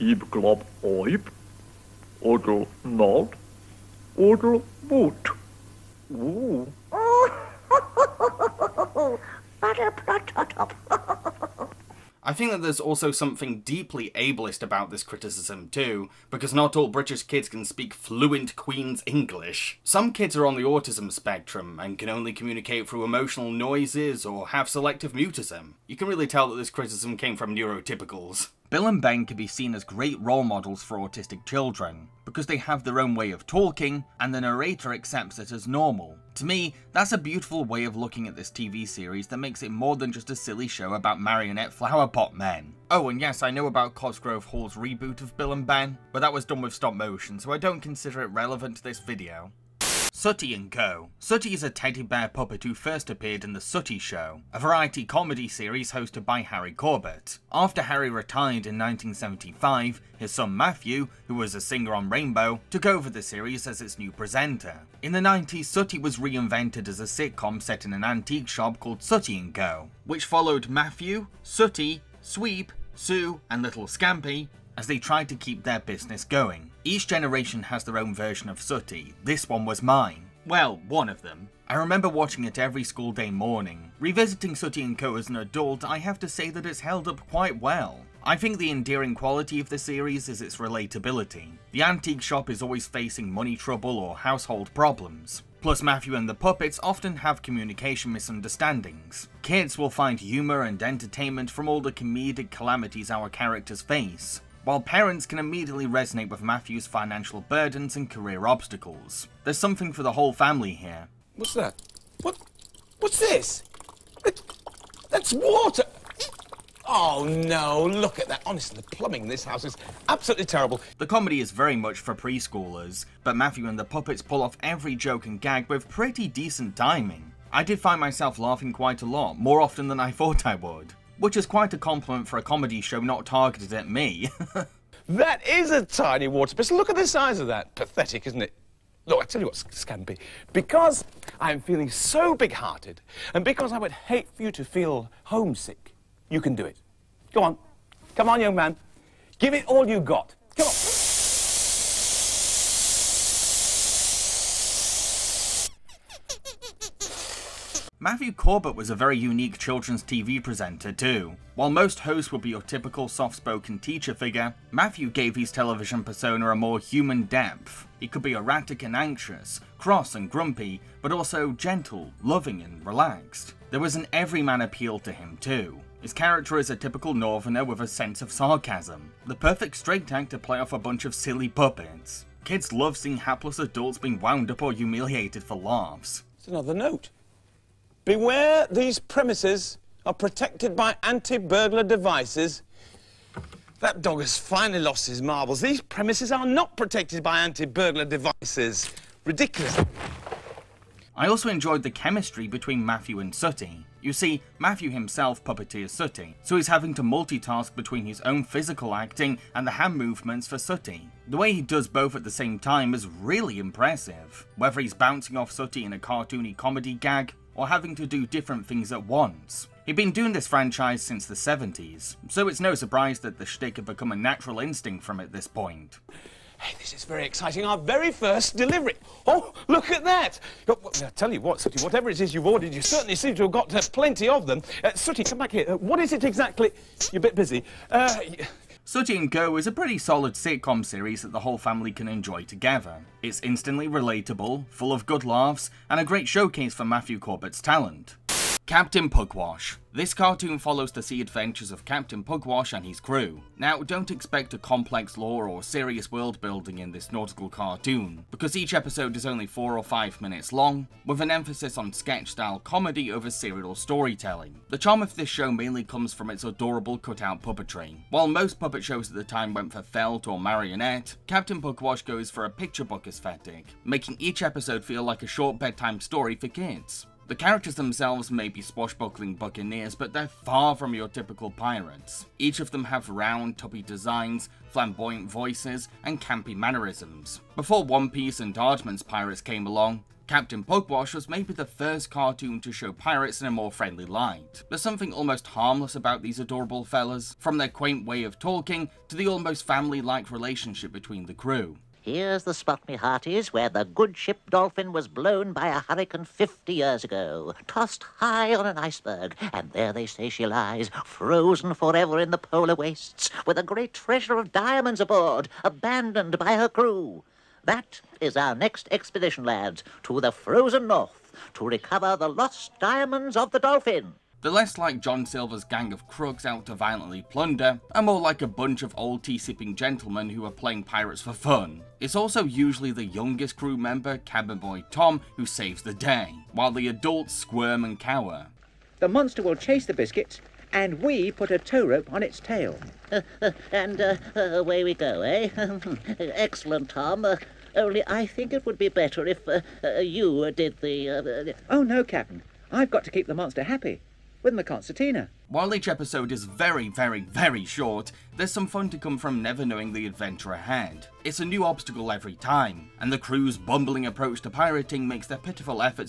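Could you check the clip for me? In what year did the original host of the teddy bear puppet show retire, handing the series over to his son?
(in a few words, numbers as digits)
1975.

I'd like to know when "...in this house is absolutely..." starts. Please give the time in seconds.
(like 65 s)
119 s.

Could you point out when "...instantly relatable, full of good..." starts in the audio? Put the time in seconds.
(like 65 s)
243 s.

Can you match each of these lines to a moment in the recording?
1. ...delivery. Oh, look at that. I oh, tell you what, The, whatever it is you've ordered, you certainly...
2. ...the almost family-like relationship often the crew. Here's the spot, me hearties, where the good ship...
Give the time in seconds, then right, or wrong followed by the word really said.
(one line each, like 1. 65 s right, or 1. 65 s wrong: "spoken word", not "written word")
1. 228 s wrong: "Sooty", not "The"
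2. 299 s wrong: "between", not "often".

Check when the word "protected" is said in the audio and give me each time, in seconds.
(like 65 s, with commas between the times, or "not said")
190 s, 196 s.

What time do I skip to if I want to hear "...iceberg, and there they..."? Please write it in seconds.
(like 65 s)
308 s.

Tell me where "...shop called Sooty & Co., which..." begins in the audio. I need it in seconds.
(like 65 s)
68 s.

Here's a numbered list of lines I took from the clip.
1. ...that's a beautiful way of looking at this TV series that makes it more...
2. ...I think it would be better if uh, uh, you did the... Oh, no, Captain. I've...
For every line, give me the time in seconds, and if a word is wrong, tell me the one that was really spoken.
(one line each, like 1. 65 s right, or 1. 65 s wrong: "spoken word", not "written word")
1. 36 s right
2. 348 s right.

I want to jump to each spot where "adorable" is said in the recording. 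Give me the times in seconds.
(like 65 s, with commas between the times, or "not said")
266 s, 296 s.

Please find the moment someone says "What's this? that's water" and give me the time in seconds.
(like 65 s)
112 s.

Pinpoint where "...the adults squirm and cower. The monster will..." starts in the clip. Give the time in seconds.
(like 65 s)
336 s.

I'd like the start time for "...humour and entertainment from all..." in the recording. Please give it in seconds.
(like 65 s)
100 s.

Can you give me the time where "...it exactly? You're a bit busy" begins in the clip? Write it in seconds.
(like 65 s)
236 s.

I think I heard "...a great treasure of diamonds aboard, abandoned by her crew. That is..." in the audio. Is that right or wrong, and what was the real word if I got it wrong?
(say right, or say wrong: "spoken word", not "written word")
right.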